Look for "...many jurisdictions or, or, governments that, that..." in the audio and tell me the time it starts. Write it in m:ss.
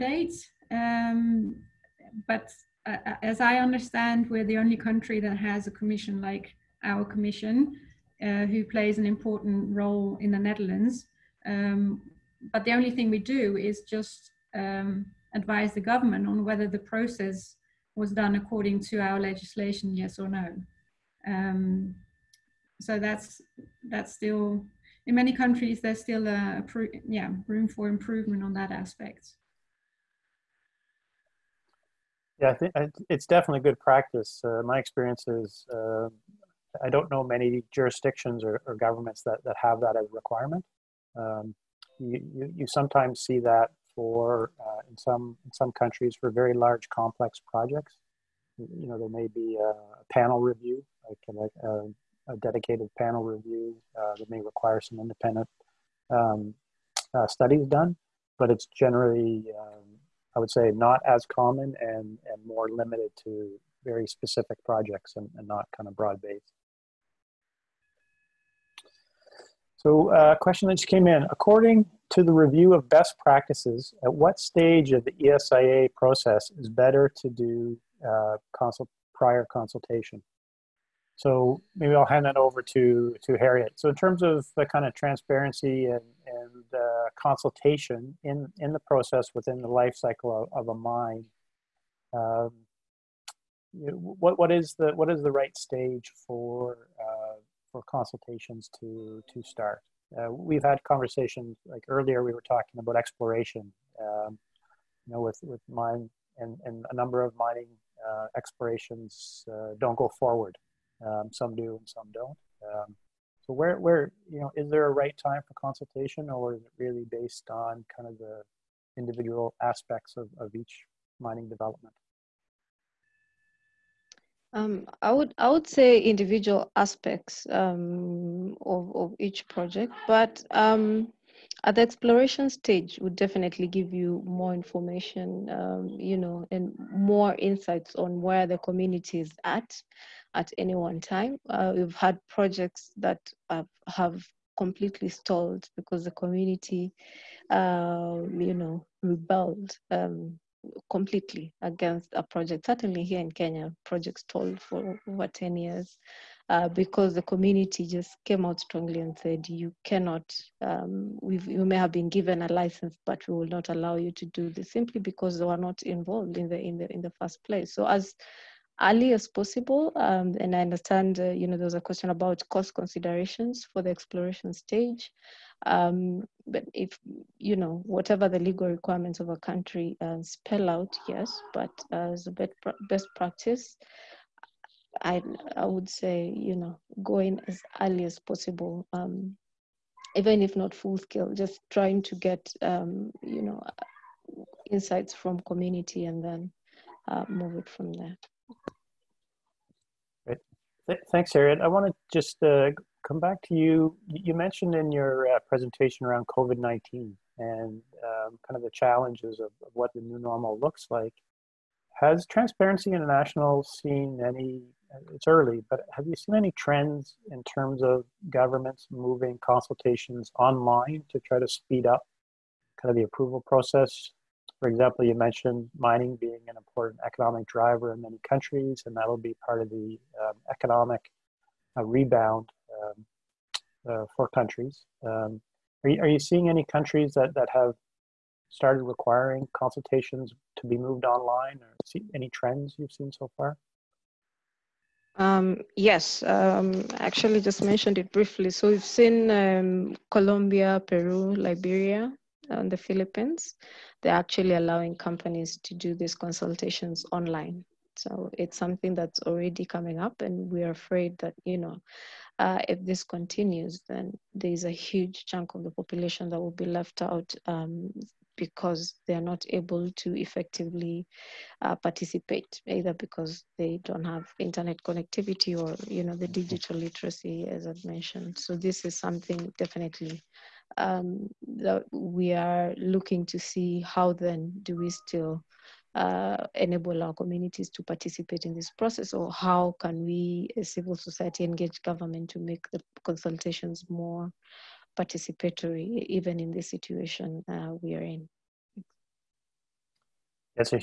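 0:37.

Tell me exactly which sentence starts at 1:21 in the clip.
So maybe I'll hand that over to, to Harriet.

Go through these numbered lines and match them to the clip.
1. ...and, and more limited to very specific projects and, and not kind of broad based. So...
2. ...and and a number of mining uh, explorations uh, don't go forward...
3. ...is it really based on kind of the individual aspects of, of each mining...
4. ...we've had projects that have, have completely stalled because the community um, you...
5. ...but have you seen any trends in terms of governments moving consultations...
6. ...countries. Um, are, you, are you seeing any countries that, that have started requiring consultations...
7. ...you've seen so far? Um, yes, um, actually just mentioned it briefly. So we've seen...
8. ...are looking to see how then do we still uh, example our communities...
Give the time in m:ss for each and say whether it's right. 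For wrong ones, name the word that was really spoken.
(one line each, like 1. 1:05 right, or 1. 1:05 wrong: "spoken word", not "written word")
1. 1:01 right
2. 1:46 right
3. 1:56 right
4. 2:21 right
5. 3:35 right
6. 3:54 right
7. 4:02 right
8. 4:42 wrong: "enable", not "example".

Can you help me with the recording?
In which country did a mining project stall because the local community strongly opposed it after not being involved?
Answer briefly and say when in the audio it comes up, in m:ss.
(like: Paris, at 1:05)
Kenya, at 2:33.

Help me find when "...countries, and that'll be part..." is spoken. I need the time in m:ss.
3:48.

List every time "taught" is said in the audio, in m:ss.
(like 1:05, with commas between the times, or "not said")
not said.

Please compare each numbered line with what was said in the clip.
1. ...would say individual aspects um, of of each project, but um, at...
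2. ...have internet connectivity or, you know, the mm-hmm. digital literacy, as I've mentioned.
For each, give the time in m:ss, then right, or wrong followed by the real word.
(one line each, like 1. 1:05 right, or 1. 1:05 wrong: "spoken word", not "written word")
1. 2:05 right
2. 4:34 right.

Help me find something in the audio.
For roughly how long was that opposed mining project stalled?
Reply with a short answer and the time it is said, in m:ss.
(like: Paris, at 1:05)
Over 10 years, at 2:35.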